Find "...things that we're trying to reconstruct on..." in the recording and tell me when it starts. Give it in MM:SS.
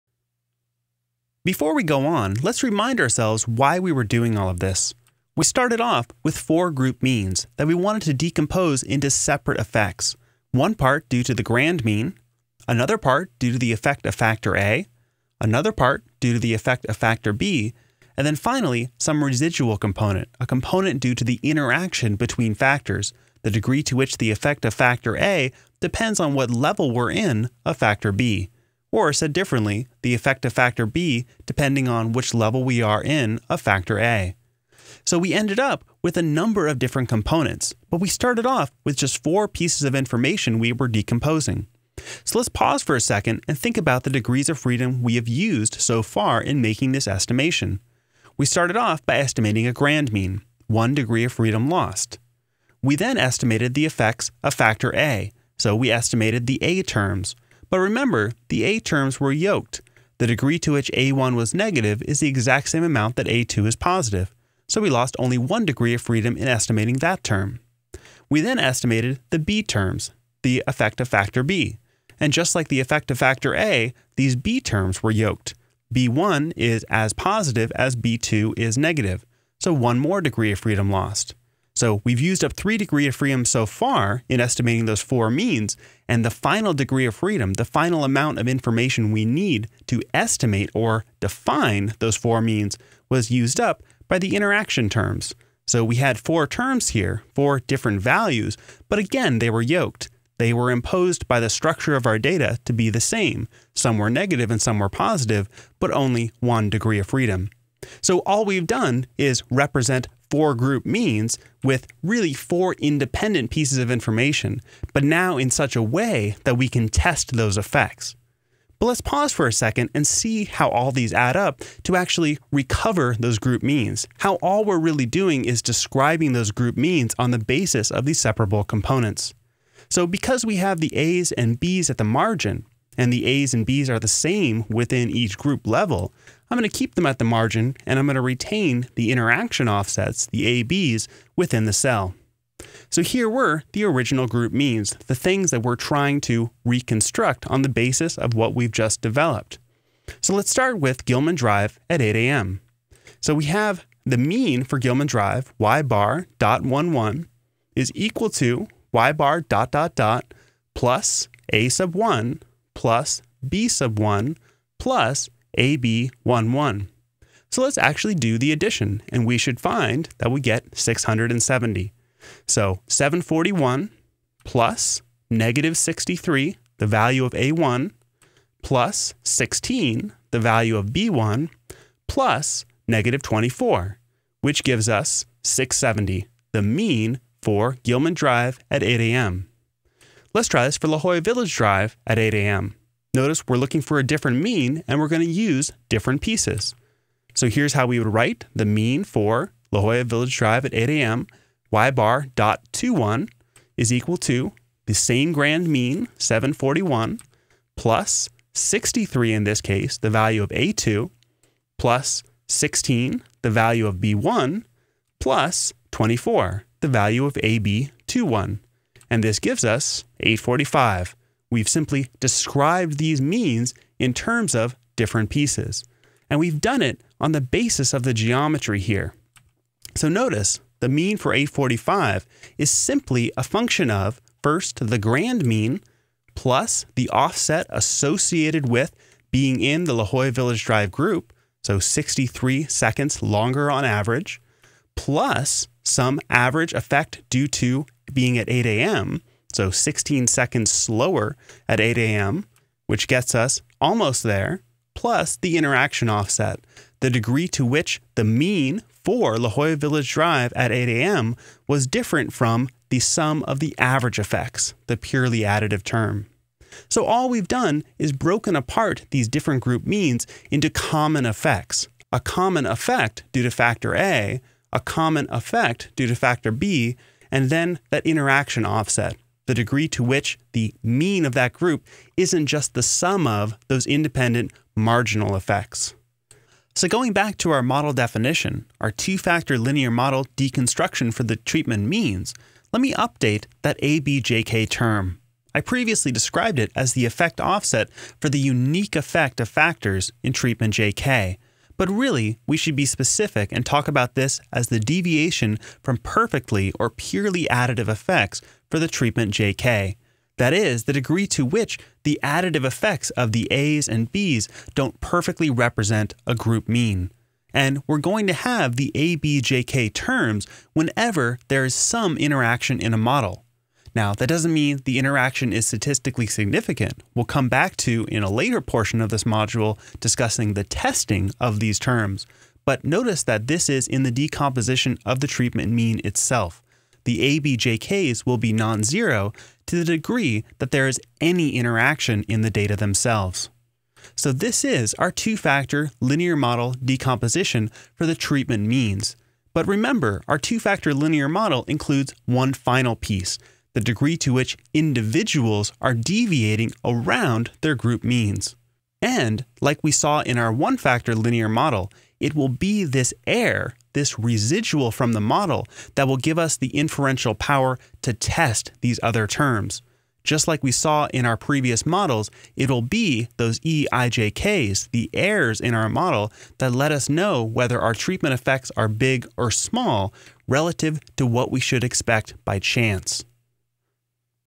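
02:25.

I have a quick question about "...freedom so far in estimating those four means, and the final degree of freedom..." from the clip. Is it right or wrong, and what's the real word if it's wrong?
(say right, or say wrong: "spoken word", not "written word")
right.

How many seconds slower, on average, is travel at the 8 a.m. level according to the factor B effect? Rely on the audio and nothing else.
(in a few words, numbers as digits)
16.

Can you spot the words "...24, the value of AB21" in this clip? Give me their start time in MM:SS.
03:35.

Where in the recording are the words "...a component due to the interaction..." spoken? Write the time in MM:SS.
00:20.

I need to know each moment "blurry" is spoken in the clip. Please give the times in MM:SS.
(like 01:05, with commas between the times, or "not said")
not said.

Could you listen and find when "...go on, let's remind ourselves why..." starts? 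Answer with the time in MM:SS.
00:01.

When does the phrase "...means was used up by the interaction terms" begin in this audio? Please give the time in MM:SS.
01:32.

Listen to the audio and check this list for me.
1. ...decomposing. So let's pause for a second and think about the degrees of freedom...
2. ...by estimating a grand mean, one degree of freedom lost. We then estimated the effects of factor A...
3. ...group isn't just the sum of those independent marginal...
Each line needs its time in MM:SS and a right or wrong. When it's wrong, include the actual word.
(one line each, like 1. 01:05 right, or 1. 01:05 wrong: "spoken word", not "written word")
1. 00:40 right
2. 00:49 right
3. 04:41 right.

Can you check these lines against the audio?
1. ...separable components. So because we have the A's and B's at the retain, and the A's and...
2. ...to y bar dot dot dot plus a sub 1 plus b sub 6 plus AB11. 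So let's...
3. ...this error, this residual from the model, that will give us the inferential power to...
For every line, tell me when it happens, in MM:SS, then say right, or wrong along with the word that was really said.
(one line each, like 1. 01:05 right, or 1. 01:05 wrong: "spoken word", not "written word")
1. 02:08 wrong: "margin", not "retain"
2. 02:38 wrong: "1", not "6"
3. 06:02 right.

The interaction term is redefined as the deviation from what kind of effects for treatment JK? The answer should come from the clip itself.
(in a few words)
purely additive effects.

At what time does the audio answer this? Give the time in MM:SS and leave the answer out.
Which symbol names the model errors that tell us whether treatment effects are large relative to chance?
06:13.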